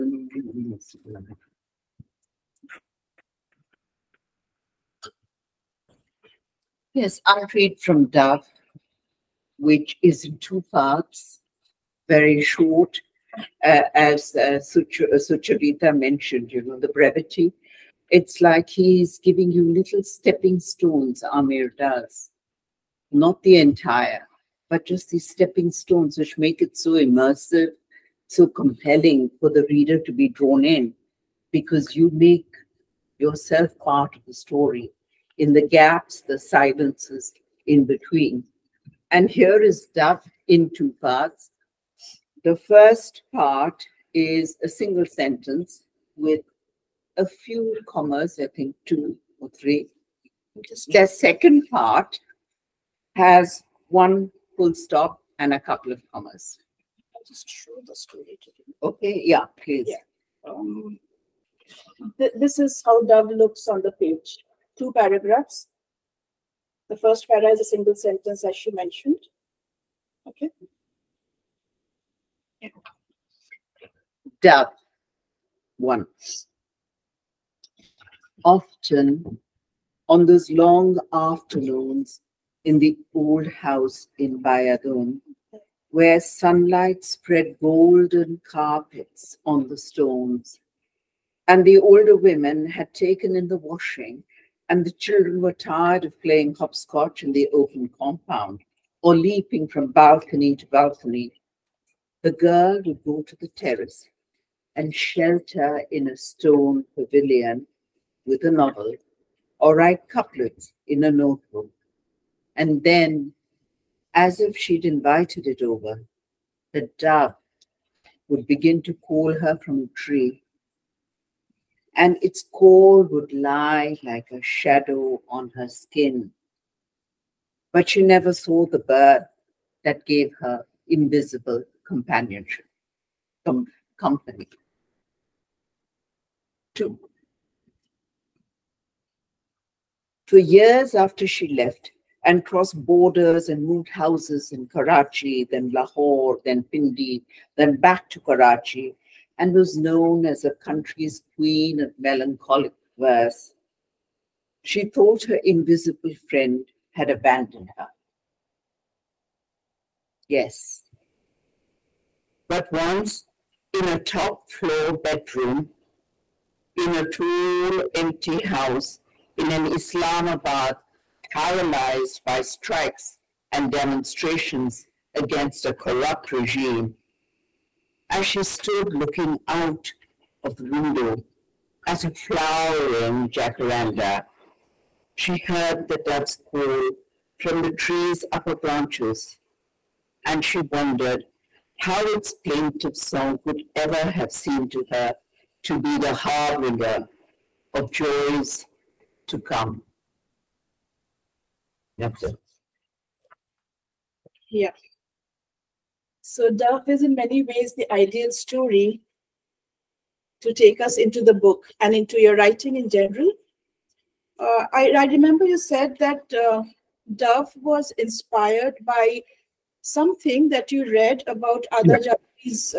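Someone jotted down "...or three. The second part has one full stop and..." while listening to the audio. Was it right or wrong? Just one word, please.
right.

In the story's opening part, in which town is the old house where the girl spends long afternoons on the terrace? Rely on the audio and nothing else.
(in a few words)
Badayun.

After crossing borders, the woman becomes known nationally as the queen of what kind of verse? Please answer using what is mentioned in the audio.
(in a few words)
Melancholic verse.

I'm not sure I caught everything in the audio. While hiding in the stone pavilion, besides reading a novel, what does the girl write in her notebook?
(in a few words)
Couplets.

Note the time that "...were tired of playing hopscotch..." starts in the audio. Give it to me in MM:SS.
01:35.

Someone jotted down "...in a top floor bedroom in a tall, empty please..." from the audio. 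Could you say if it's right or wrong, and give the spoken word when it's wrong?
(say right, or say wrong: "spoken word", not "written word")
wrong: "house", not "please".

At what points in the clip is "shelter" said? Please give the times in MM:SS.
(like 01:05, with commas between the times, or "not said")
01:44.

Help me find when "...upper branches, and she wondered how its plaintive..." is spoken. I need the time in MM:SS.
03:08.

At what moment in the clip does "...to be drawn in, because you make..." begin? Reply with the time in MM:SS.
00:29.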